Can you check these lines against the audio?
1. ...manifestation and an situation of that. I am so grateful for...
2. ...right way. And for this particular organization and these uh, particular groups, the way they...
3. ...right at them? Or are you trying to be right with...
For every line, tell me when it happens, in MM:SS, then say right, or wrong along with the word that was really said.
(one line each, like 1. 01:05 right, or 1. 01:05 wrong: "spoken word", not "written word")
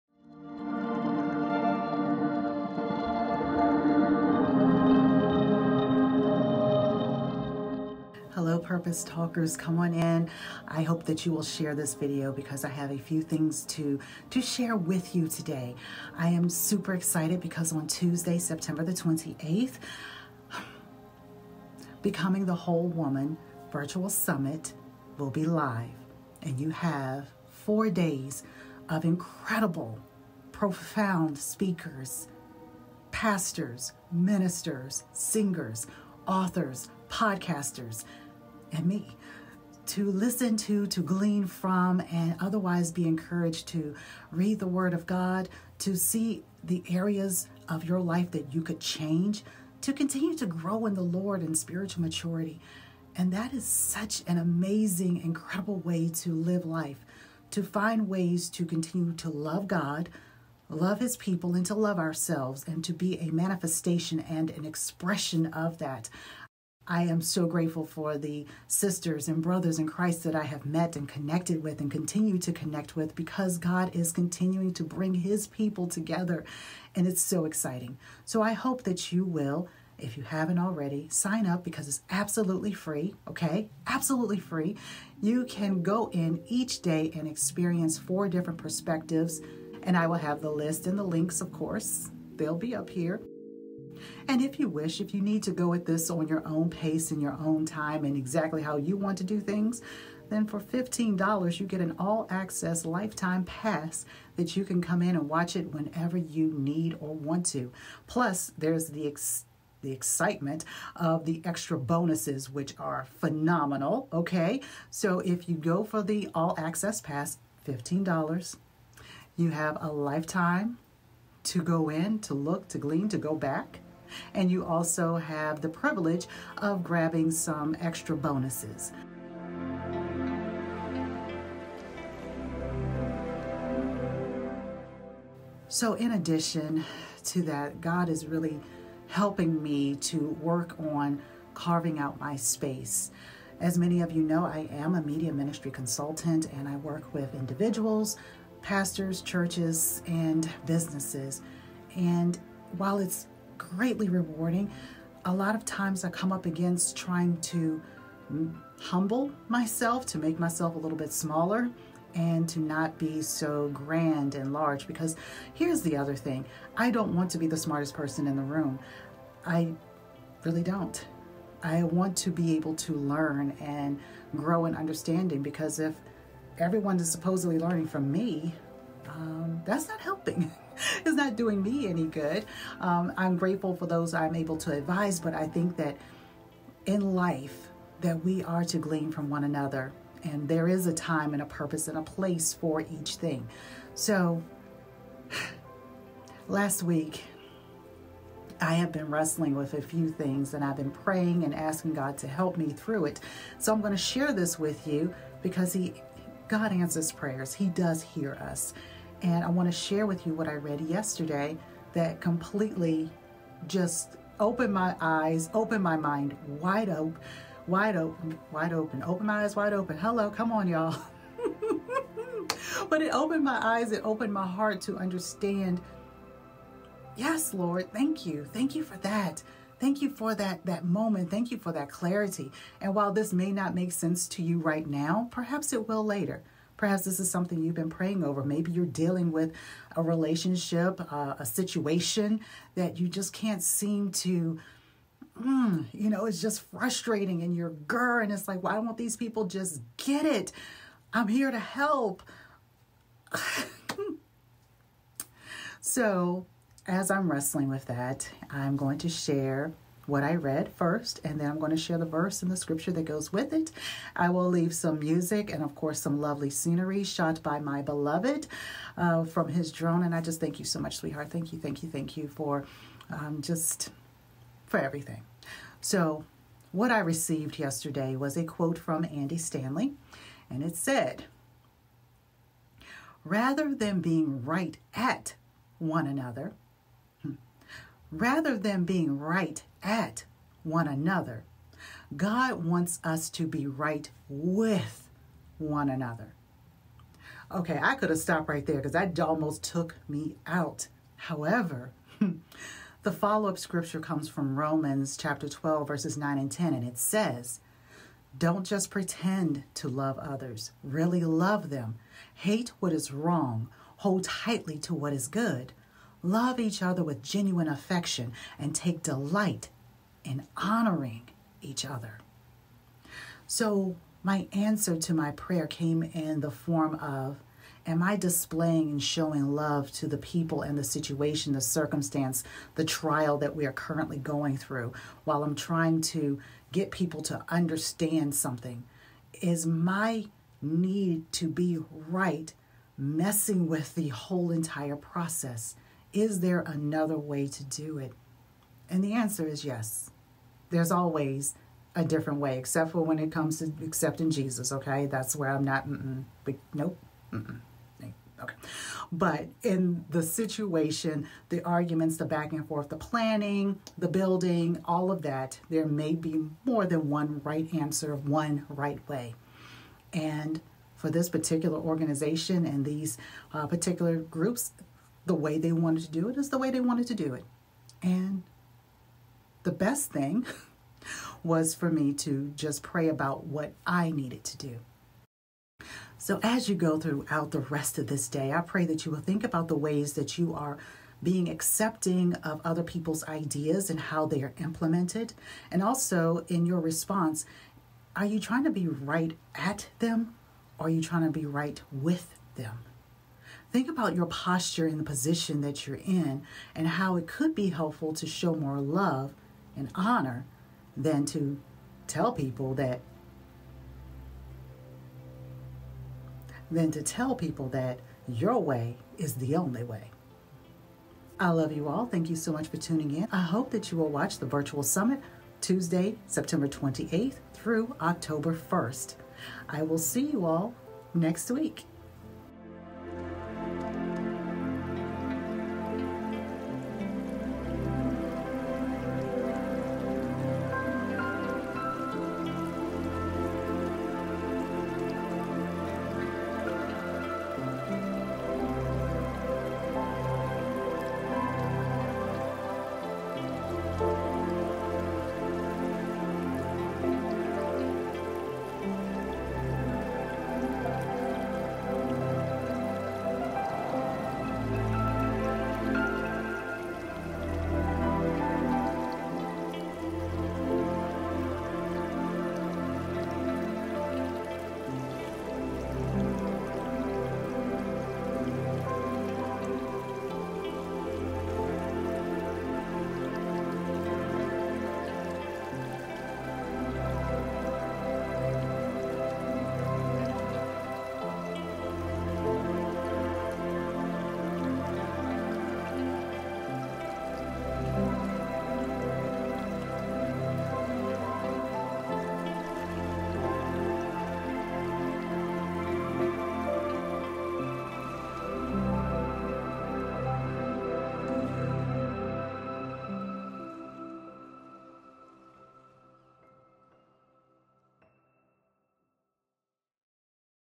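1. 01:03 wrong: "expression", not "situation"
2. 06:08 right
3. 06:38 right.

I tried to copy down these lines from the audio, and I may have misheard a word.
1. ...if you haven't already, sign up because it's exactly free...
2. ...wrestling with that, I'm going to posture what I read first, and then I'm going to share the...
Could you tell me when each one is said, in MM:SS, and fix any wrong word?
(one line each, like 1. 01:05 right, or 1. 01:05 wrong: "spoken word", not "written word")
1. 01:19 wrong: "absolutely", not "exactly"
2. 04:17 wrong: "share", not "posture".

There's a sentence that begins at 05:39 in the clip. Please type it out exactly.
Is my need to be right messing with the whole entire process?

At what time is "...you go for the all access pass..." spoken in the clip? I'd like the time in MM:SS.
01:55.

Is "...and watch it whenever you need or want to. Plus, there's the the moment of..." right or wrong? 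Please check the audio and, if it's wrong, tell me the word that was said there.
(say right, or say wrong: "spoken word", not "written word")
wrong: "excitement", not "moment".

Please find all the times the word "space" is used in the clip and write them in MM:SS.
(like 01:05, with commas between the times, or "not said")
02:22.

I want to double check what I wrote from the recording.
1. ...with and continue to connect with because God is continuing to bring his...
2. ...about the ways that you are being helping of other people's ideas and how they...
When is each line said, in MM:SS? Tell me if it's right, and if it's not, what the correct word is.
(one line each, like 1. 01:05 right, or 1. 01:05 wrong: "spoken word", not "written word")
1. 01:11 right
2. 06:29 wrong: "accepting", not "helping".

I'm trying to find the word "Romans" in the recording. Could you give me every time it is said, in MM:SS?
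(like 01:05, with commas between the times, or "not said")
05:04.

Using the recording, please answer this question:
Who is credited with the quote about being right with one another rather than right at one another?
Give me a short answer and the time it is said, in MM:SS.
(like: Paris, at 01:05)
Andy Stanley, at 04:39.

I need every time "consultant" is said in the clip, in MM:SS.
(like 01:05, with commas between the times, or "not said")
02:25.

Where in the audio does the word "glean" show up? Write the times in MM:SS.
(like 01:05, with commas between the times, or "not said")
00:41, 02:02, 03:08.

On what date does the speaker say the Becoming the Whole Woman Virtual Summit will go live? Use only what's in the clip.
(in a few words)
Tuesday, September 28th.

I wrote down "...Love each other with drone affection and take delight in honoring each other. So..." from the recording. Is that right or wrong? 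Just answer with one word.
wrong.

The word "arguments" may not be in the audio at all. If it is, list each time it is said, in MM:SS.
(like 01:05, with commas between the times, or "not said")
06:01.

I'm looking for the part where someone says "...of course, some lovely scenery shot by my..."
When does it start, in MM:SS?
04:25.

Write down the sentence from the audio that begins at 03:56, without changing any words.
Perhaps this is something you've been praying over.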